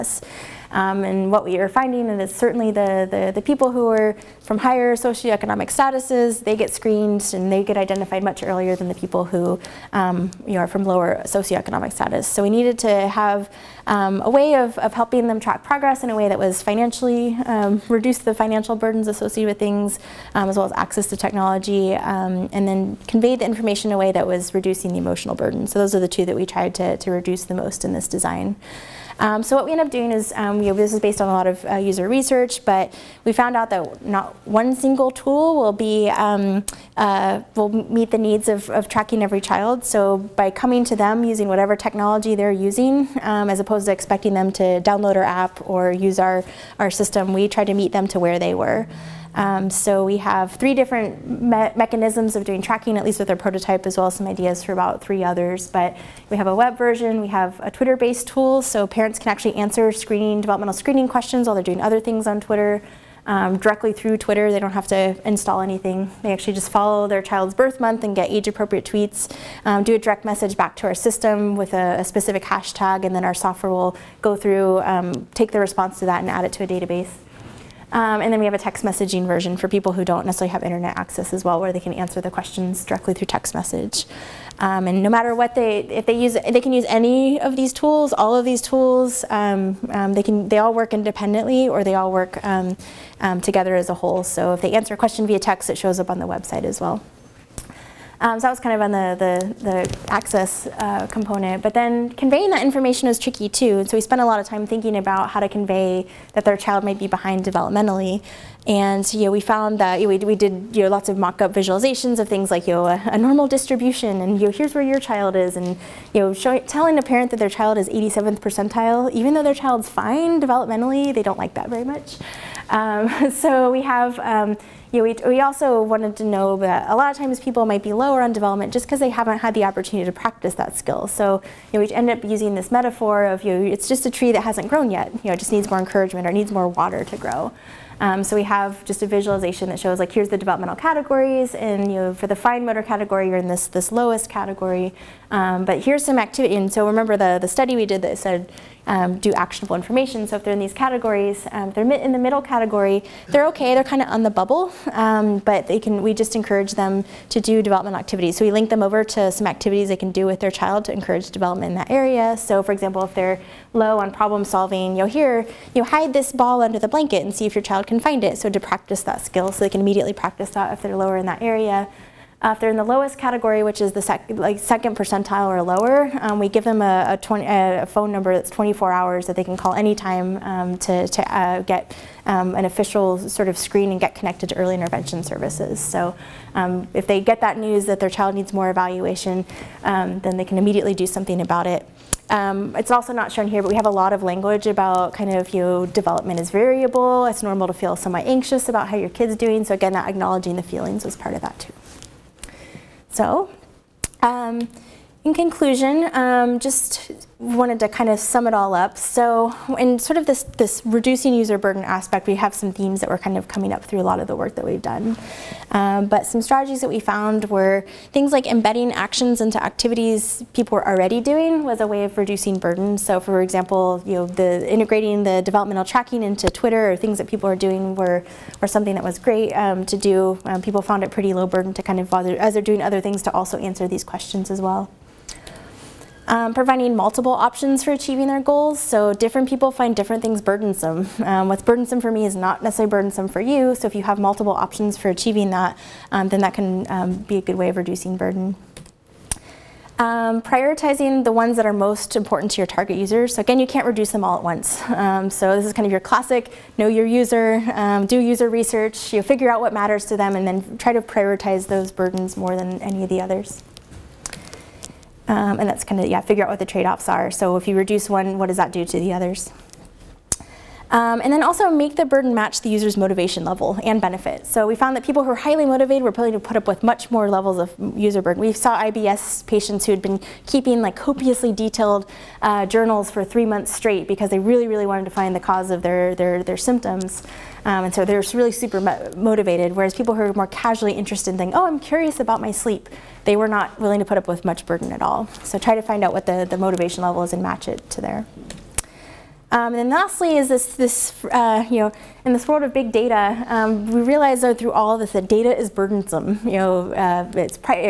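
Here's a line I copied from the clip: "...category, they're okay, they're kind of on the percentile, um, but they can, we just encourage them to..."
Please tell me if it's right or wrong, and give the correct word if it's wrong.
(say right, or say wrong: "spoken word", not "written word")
wrong: "bubble", not "percentile".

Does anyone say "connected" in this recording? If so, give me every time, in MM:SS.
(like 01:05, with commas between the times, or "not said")
03:04.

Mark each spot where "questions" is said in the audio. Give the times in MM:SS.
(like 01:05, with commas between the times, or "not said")
01:01, 01:22, 01:34, 03:54.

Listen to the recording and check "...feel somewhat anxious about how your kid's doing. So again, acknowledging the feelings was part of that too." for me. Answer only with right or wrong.
right.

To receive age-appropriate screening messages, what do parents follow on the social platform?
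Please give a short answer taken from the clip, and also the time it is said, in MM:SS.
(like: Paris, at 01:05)
Their child's birth month, at 01:07.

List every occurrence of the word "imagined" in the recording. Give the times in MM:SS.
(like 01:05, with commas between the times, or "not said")
not said.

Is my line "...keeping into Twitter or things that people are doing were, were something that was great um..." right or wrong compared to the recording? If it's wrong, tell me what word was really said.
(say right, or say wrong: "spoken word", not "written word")
wrong: "tracking", not "keeping".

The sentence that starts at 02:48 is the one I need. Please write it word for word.
So to practice that skill so they can immediately practice that if they're lower in that area.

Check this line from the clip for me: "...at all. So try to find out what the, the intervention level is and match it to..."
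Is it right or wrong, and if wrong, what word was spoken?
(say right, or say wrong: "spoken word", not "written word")
wrong: "motivation", not "intervention".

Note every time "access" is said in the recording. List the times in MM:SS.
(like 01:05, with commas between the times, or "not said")
00:20, 01:20, 01:40.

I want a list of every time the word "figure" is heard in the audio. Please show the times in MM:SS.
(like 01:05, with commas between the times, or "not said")
04:19, 04:26.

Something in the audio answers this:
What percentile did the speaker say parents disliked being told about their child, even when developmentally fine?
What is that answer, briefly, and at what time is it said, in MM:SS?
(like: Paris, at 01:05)
87th percentile, at 01:57.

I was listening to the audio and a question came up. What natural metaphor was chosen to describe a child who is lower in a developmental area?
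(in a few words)
A tree.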